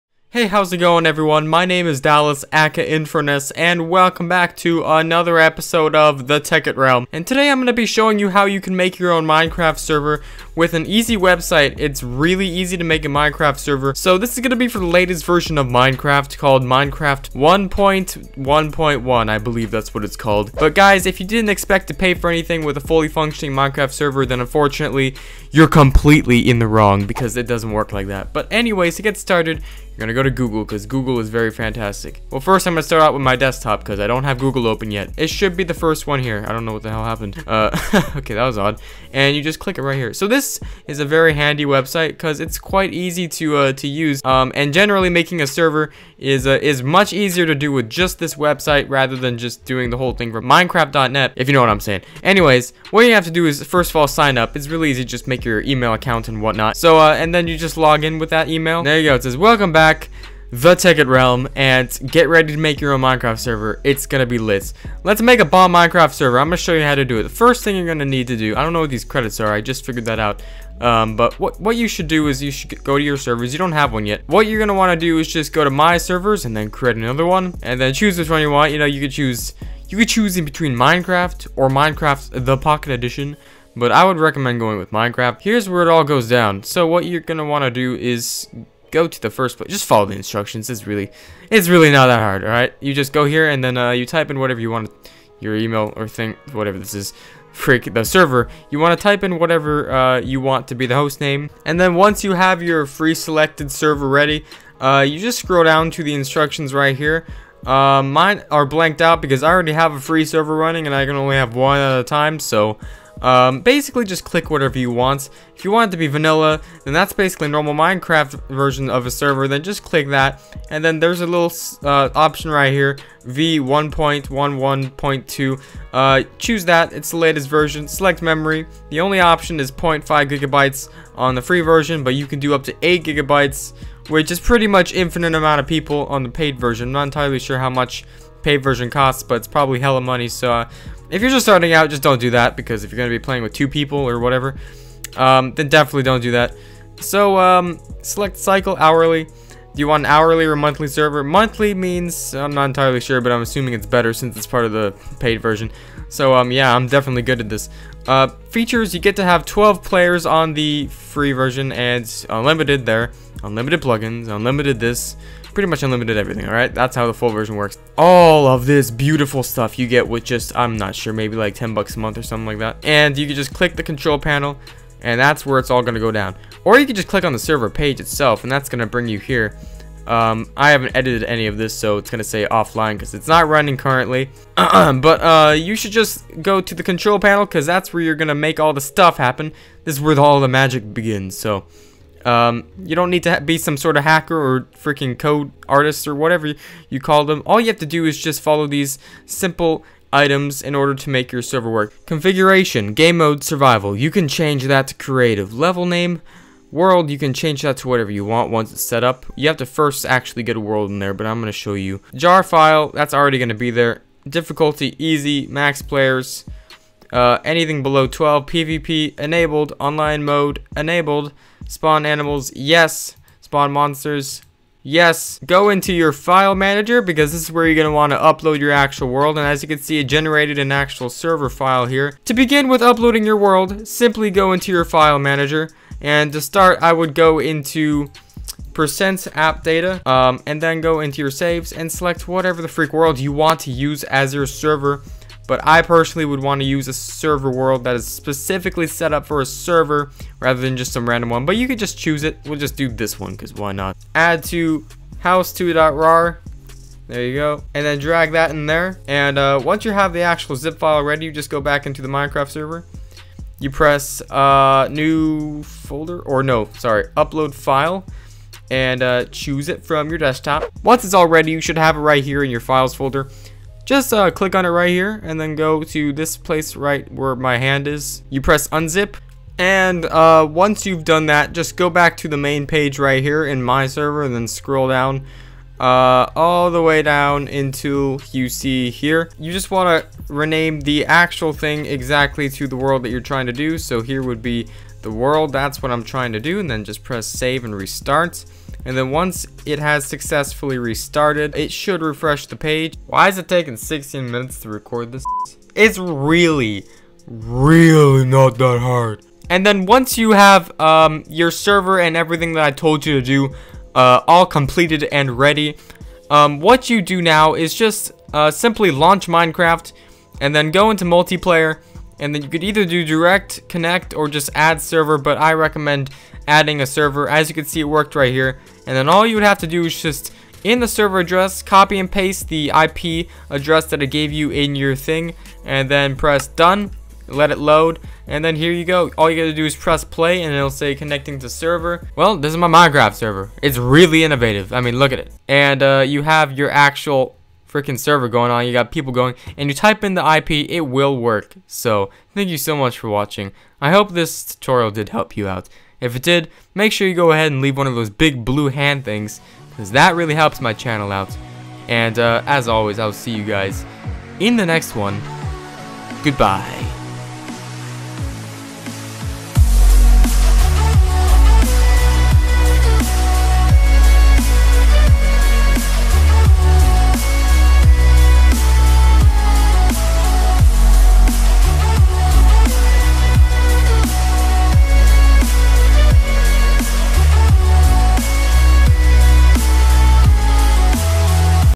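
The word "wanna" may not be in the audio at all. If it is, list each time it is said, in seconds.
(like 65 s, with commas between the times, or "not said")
74 s, 87 s.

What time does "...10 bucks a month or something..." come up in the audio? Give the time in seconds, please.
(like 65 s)
171 s.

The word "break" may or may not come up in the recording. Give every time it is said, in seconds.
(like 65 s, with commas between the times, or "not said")
not said.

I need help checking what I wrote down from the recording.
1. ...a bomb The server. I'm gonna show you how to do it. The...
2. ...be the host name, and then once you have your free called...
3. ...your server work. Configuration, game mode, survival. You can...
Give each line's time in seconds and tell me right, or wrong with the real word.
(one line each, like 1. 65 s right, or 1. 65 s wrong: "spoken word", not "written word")
1. 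65 s wrong: "Minecraft", not "The"
2. 100 s wrong: "selected", not "called"
3. 201 s right.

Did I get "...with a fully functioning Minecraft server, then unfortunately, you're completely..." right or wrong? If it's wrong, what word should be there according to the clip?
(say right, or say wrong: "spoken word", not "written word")
right.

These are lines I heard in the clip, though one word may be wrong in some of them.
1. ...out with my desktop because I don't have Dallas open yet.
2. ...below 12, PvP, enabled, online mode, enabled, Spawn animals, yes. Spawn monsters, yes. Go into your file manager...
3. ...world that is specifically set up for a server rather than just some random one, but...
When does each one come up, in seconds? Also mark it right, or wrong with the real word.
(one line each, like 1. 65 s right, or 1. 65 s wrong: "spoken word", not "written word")
1. 33 s wrong: "Google", not "Dallas"
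2. 217 s right
3. 247 s right.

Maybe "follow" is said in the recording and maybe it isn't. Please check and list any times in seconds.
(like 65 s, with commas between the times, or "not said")
89 s, 198 s.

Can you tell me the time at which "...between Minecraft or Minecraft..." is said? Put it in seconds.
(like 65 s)
80 s.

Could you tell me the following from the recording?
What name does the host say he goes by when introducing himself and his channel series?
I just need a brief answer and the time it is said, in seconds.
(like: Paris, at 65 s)
Infurness, at 2 s.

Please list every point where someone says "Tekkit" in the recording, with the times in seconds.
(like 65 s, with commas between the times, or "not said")
6 s, 60 s.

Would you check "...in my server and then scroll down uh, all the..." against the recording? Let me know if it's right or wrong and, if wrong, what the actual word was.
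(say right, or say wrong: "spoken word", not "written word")
right.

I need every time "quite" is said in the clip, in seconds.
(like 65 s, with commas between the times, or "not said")
42 s.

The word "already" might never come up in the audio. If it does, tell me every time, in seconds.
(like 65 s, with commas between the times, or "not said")
109 s, 213 s.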